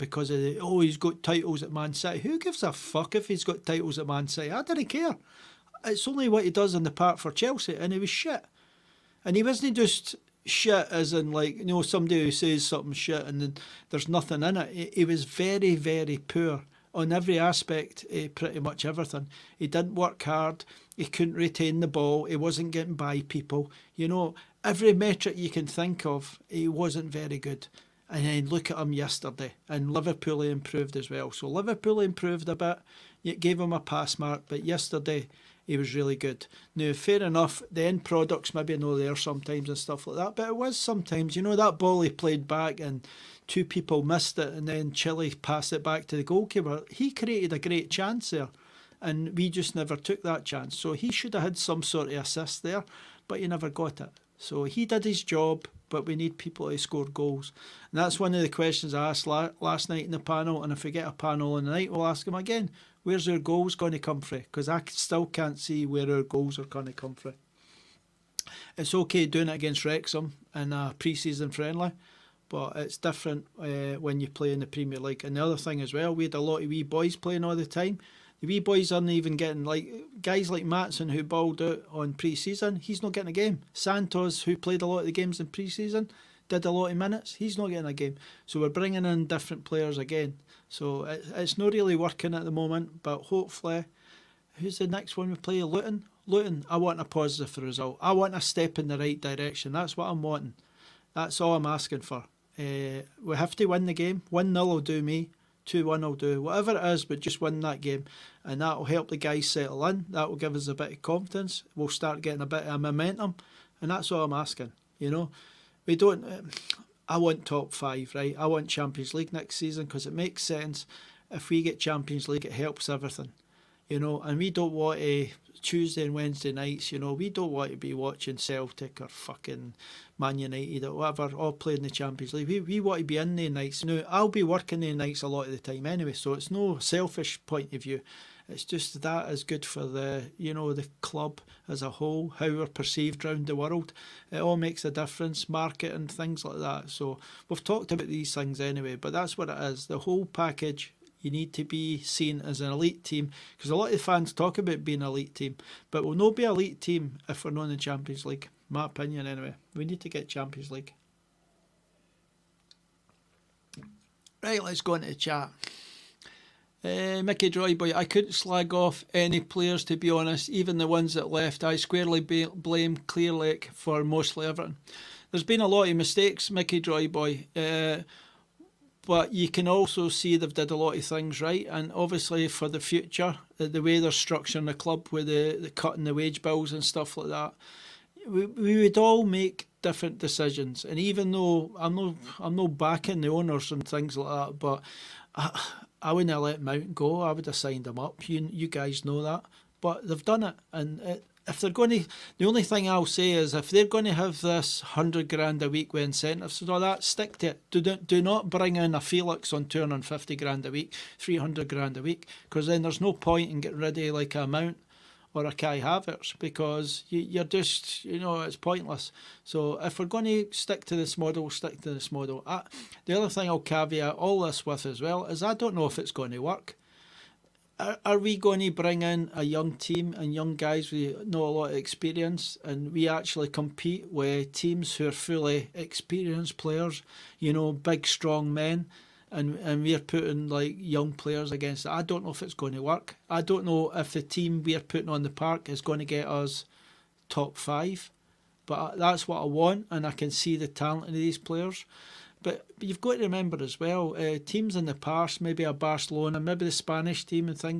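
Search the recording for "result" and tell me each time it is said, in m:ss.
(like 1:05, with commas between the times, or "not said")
1:37.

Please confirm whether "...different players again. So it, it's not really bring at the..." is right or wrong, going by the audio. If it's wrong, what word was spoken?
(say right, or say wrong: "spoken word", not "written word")
wrong: "working", not "bring".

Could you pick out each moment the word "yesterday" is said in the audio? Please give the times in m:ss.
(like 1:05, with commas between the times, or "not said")
0:28, 0:34.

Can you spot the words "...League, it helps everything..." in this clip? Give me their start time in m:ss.
2:02.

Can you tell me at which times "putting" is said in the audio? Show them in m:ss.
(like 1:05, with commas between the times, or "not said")
3:59, 4:04.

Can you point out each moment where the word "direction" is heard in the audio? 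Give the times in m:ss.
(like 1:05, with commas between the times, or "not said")
1:39.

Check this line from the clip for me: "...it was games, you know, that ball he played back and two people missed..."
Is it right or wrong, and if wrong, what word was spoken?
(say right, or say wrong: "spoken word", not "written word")
wrong: "sometimes", not "games".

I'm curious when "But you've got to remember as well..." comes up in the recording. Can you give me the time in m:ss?
4:12.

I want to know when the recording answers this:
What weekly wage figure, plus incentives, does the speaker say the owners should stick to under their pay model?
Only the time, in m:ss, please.
3:24.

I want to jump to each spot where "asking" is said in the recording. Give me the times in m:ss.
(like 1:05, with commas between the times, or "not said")
1:41, 1:54.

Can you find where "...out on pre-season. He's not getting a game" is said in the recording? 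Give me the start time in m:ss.
1:21.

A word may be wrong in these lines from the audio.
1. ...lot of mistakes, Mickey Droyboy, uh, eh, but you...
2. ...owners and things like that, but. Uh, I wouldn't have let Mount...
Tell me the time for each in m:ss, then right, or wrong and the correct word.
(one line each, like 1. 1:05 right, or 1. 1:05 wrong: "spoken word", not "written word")
1. 2:55 right
2. 3:13 right.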